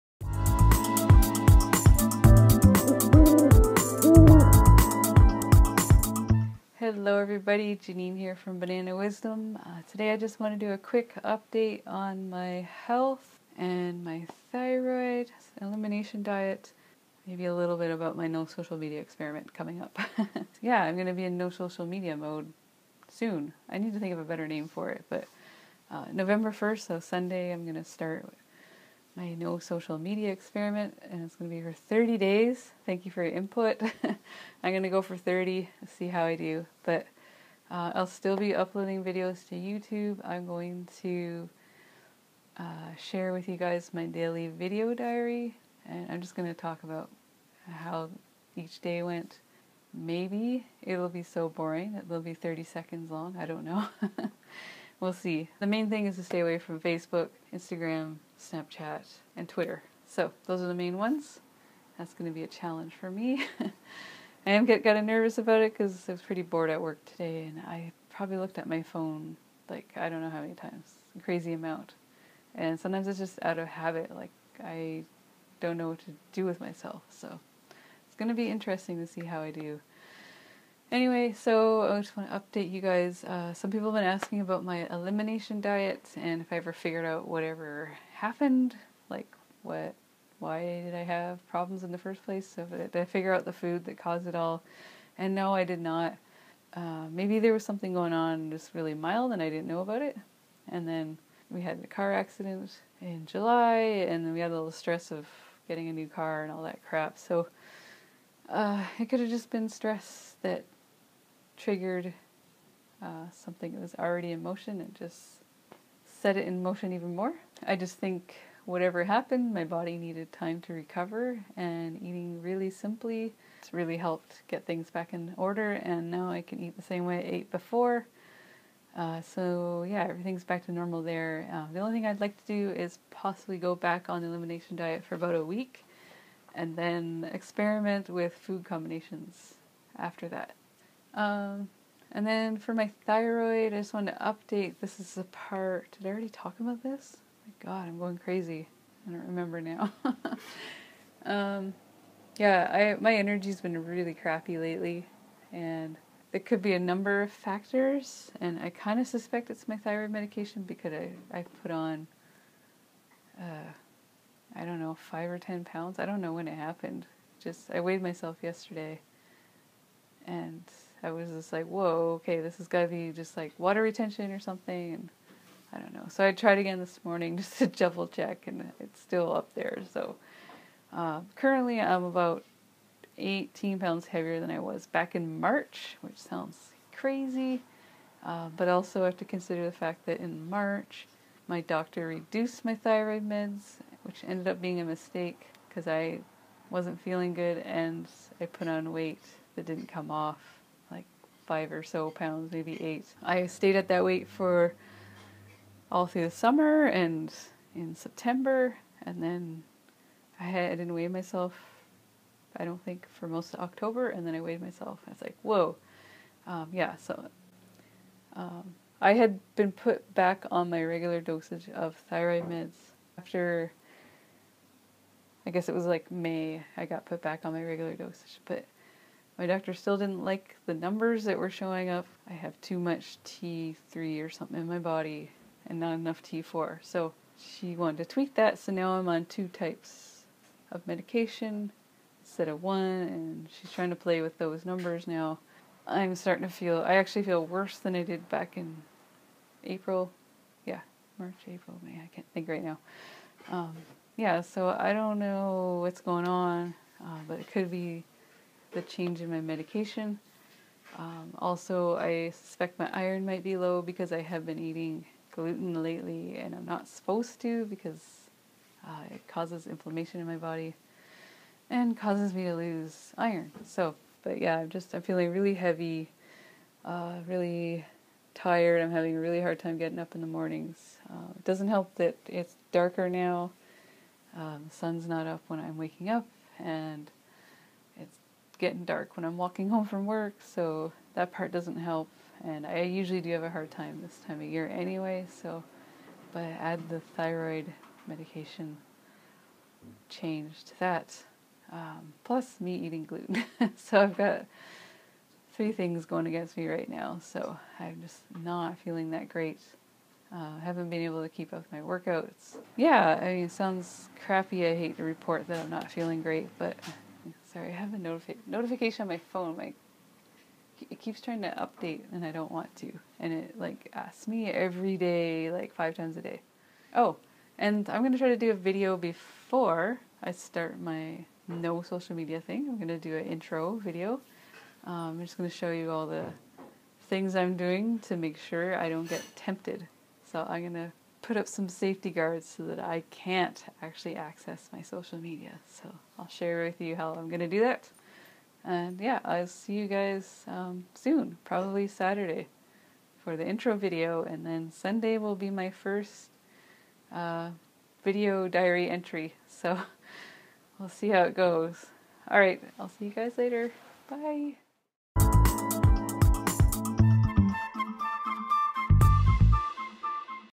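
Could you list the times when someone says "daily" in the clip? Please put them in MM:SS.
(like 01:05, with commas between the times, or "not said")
00:44.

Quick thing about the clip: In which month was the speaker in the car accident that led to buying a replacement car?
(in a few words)
July.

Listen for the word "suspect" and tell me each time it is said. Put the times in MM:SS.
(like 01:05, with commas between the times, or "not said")
02:39, 04:22.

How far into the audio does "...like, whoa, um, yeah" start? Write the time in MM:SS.
03:35.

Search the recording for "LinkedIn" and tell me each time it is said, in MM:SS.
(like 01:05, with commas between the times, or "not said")
not said.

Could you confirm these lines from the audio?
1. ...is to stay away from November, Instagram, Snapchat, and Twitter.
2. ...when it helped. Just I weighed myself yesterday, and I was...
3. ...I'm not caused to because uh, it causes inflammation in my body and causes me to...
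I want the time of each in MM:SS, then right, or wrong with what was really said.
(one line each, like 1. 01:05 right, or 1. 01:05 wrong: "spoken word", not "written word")
1. 00:56 wrong: "Facebook", not "November"
2. 02:46 wrong: "happened", not "helped"
3. 04:26 wrong: "supposed", not "caused".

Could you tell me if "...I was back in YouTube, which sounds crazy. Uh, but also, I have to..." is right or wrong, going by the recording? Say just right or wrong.
wrong.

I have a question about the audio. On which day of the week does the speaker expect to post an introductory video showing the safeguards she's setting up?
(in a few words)
Saturday.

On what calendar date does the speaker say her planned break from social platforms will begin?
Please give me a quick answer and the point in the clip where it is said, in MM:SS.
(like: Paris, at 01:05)
November 1st, at 00:26.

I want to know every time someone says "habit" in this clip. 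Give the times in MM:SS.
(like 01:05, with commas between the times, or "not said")
01:13.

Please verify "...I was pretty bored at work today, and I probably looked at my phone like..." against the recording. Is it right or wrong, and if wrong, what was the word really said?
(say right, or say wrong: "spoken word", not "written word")
right.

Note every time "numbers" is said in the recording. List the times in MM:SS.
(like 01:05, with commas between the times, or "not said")
02:36, 03:50, 04:04.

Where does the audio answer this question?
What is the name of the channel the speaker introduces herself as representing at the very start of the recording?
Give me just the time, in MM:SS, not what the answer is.
00:08.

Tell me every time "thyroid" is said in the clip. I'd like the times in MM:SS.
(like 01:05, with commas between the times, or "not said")
00:14, 02:23, 02:39, 03:12, 03:42, 04:57.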